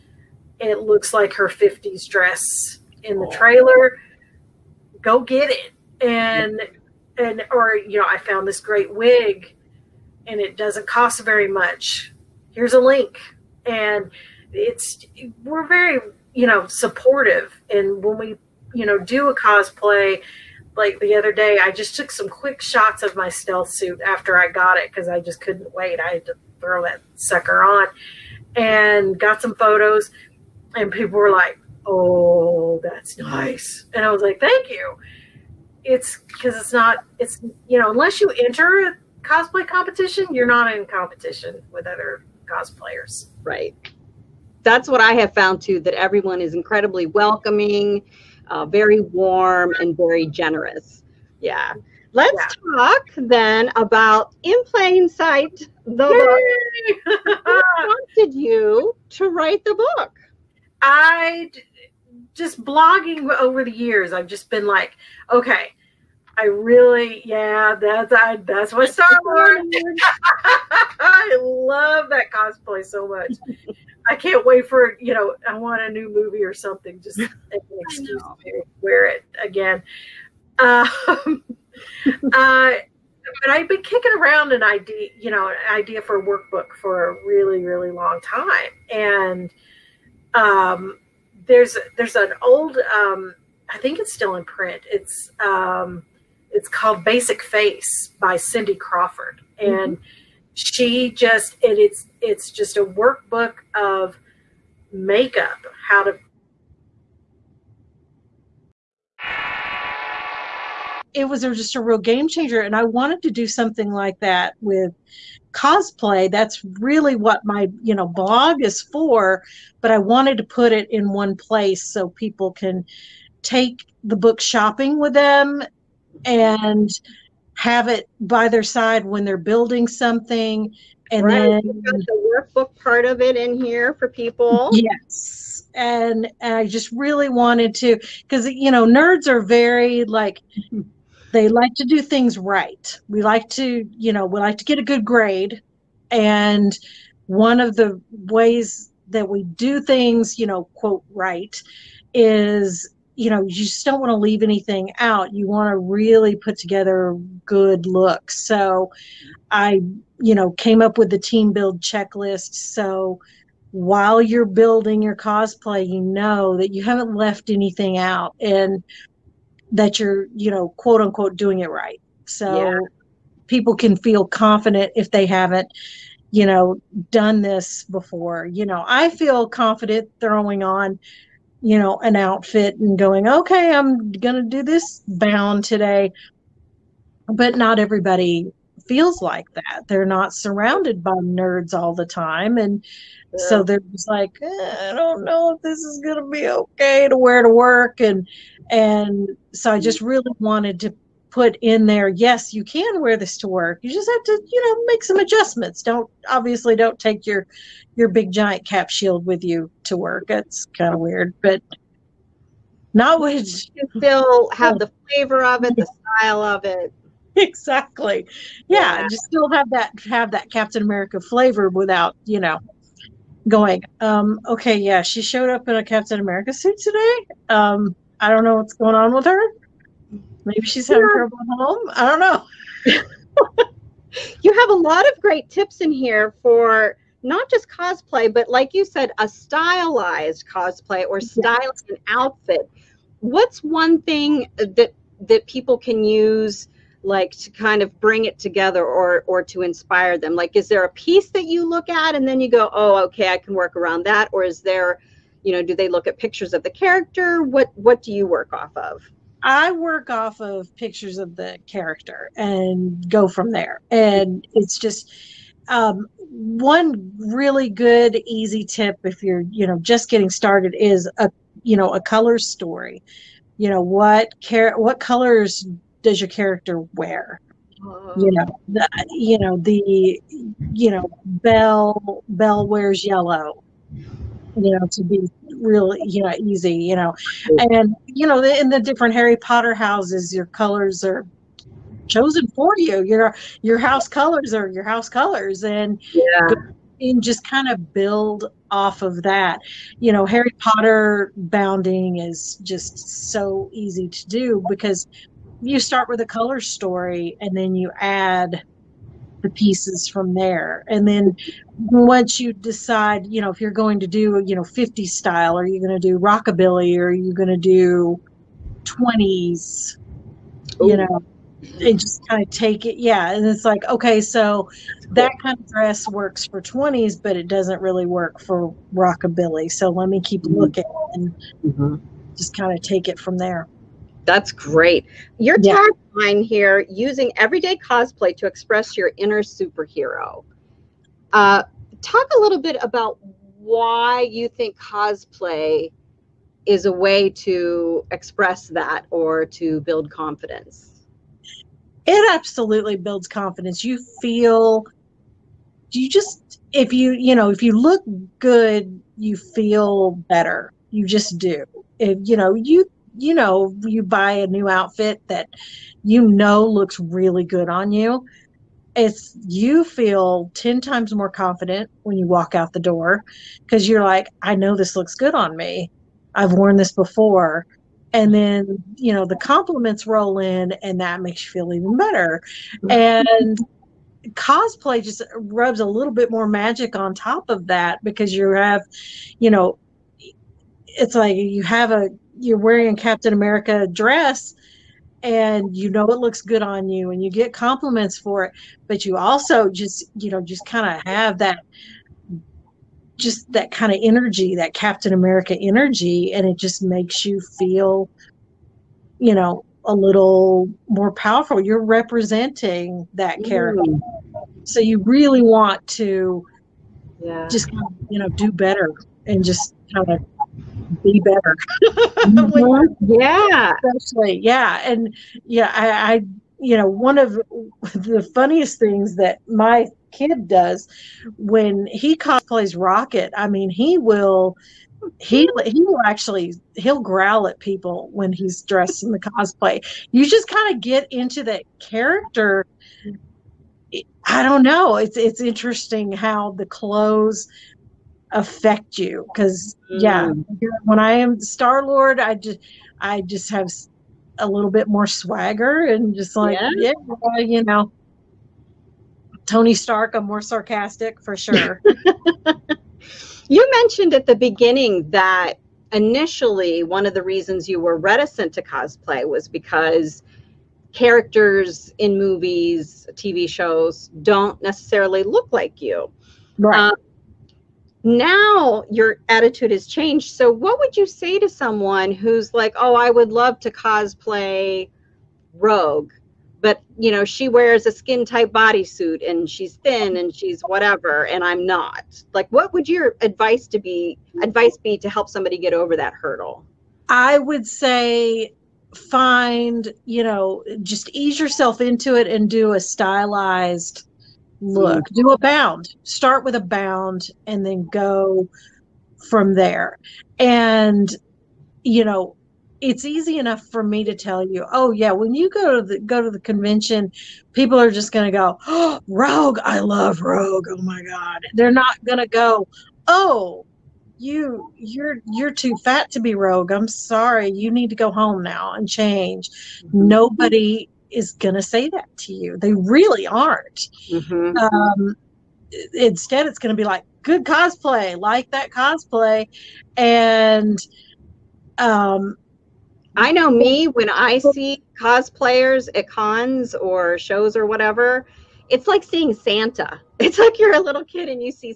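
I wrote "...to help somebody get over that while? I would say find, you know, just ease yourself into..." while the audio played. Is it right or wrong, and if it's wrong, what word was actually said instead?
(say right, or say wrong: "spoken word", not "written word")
wrong: "hurdle", not "while".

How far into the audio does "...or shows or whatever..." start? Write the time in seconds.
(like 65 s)
546 s.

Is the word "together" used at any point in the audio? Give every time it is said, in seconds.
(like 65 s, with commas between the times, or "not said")
156 s, 248 s.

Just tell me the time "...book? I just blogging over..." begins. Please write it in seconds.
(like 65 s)
59 s.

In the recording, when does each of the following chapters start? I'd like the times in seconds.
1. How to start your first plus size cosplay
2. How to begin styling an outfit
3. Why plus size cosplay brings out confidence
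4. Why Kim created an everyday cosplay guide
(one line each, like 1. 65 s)
1. 462 s
2. 233 s
3. 334 s
4. 52 s.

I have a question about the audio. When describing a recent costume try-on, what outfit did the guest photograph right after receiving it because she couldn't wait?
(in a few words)
stealth suit.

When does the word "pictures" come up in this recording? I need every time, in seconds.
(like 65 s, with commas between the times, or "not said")
256 s, 260 s.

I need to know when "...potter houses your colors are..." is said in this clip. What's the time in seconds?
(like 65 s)
289 s.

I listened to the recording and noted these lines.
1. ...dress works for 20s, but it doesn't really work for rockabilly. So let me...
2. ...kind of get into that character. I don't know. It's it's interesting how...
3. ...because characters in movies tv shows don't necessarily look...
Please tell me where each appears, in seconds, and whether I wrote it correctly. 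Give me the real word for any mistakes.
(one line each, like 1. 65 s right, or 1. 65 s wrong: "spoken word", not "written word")
1. 325 s right
2. 440 s right
3. 469 s right.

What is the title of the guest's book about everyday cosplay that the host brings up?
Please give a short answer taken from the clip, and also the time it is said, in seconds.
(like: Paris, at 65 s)
In Plain Sight, at 54 s.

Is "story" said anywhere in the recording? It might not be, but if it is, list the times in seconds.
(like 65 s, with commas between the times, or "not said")
272 s, 306 s.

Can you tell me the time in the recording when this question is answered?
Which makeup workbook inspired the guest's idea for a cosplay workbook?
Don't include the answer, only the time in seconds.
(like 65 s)
97 s.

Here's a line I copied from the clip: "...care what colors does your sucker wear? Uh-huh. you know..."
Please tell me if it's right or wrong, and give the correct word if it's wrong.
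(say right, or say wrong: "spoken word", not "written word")
wrong: "character", not "sucker".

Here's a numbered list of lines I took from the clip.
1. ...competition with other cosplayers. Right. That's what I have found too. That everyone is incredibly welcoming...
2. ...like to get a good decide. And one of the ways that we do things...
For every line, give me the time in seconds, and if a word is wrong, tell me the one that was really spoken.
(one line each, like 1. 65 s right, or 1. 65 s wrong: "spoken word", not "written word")
1. 40 s right
2. 144 s wrong: "grade", not "decide".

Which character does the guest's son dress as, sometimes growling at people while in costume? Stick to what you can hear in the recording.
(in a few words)
Rocket.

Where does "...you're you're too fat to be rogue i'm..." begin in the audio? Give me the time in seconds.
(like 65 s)
524 s.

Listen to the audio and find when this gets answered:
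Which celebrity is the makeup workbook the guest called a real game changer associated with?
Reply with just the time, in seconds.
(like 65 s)
98 s.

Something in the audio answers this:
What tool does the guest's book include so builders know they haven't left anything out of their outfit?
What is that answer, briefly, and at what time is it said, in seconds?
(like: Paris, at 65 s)
team build checklist, at 161 s.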